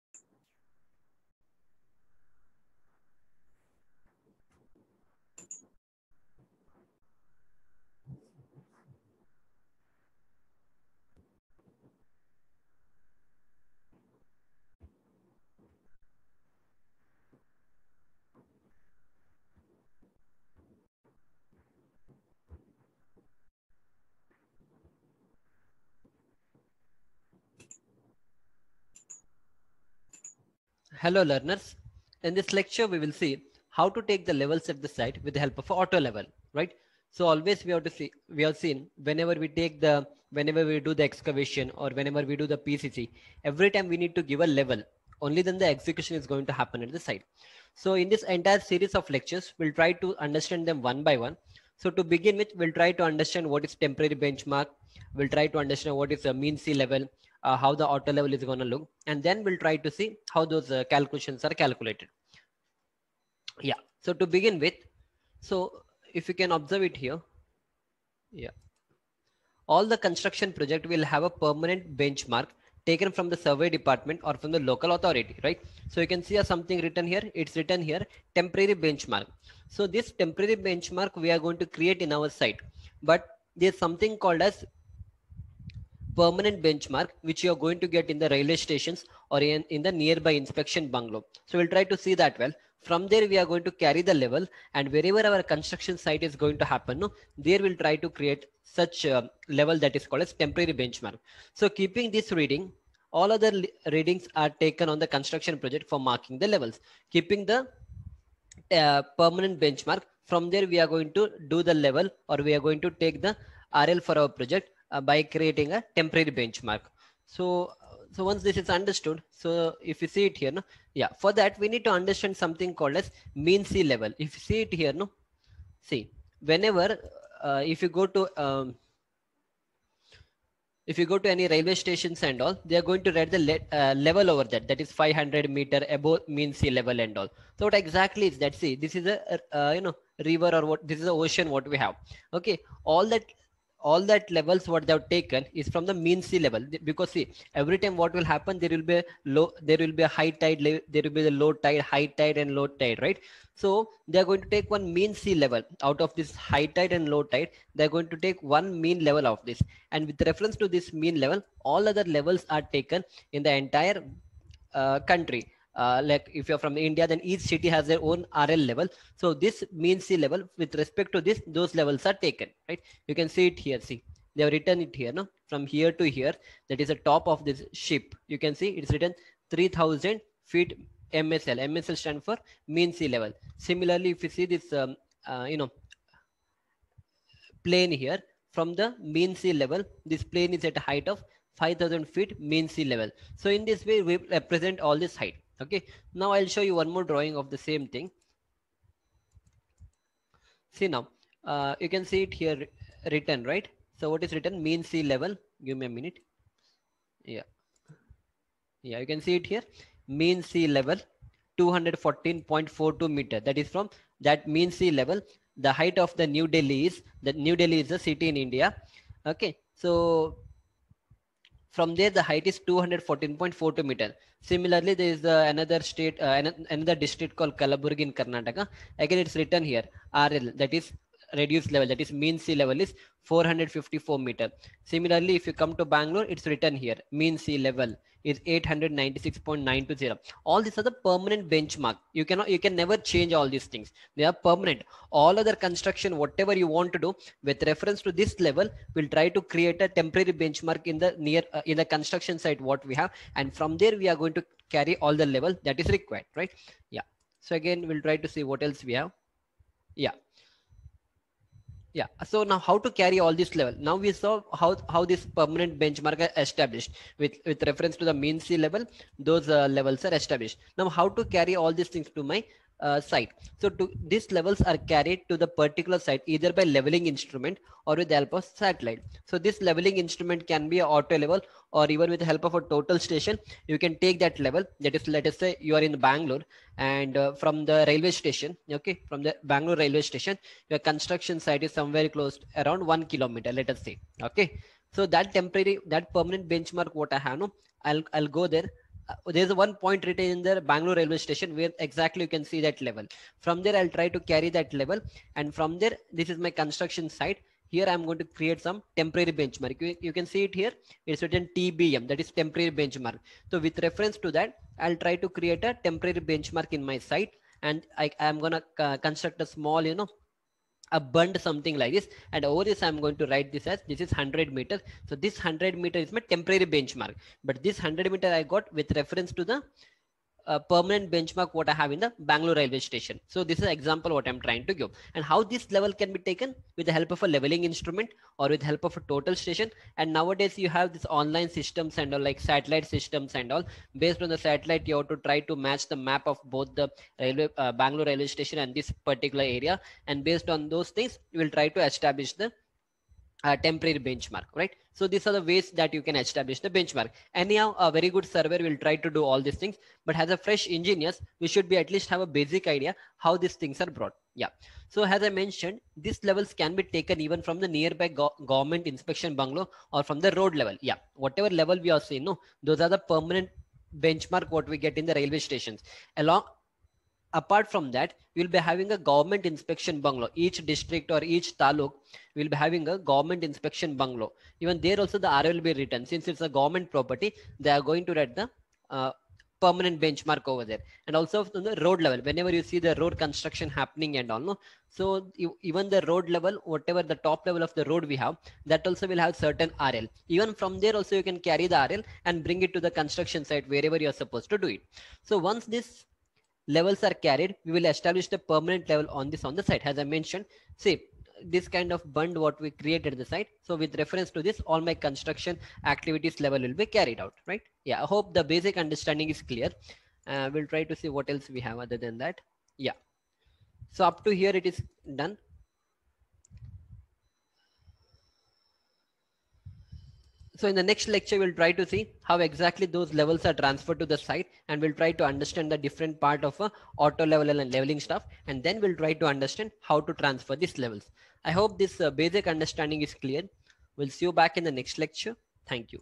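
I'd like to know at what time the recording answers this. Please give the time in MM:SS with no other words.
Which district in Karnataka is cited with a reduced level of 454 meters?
03:47.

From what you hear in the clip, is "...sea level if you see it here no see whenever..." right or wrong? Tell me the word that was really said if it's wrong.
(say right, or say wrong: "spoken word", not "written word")
right.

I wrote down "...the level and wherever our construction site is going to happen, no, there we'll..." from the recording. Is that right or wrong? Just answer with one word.
right.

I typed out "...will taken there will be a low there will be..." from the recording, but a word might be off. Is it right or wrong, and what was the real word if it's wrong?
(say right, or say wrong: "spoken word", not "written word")
wrong: "happen", not "taken".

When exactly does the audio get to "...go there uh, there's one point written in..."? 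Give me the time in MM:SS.
04:58.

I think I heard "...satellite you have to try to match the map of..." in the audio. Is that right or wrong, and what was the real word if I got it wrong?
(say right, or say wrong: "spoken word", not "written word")
right.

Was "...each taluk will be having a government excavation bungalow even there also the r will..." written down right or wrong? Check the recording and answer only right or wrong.
wrong.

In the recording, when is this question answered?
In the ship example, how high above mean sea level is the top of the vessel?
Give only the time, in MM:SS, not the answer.
02:59.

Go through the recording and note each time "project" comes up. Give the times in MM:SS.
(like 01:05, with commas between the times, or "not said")
01:10, 01:45, 01:54.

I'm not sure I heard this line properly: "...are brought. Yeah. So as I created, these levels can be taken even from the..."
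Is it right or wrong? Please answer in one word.
wrong.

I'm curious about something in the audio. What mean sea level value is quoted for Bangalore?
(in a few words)
896.920.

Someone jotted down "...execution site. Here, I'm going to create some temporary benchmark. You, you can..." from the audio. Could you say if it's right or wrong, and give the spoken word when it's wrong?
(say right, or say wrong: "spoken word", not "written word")
wrong: "construction", not "execution".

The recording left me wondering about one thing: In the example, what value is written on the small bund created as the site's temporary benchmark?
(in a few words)
100 meters.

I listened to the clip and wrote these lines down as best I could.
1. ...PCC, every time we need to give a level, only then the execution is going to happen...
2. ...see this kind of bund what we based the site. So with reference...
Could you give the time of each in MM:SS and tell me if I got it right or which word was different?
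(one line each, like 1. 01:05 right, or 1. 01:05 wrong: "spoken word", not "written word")
1. 00:42 right
2. 06:50 wrong: "created", not "based".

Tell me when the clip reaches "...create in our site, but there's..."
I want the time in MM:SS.
01:21.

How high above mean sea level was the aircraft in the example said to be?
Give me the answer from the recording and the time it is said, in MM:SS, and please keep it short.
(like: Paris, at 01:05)
5000 feet, at 03:11.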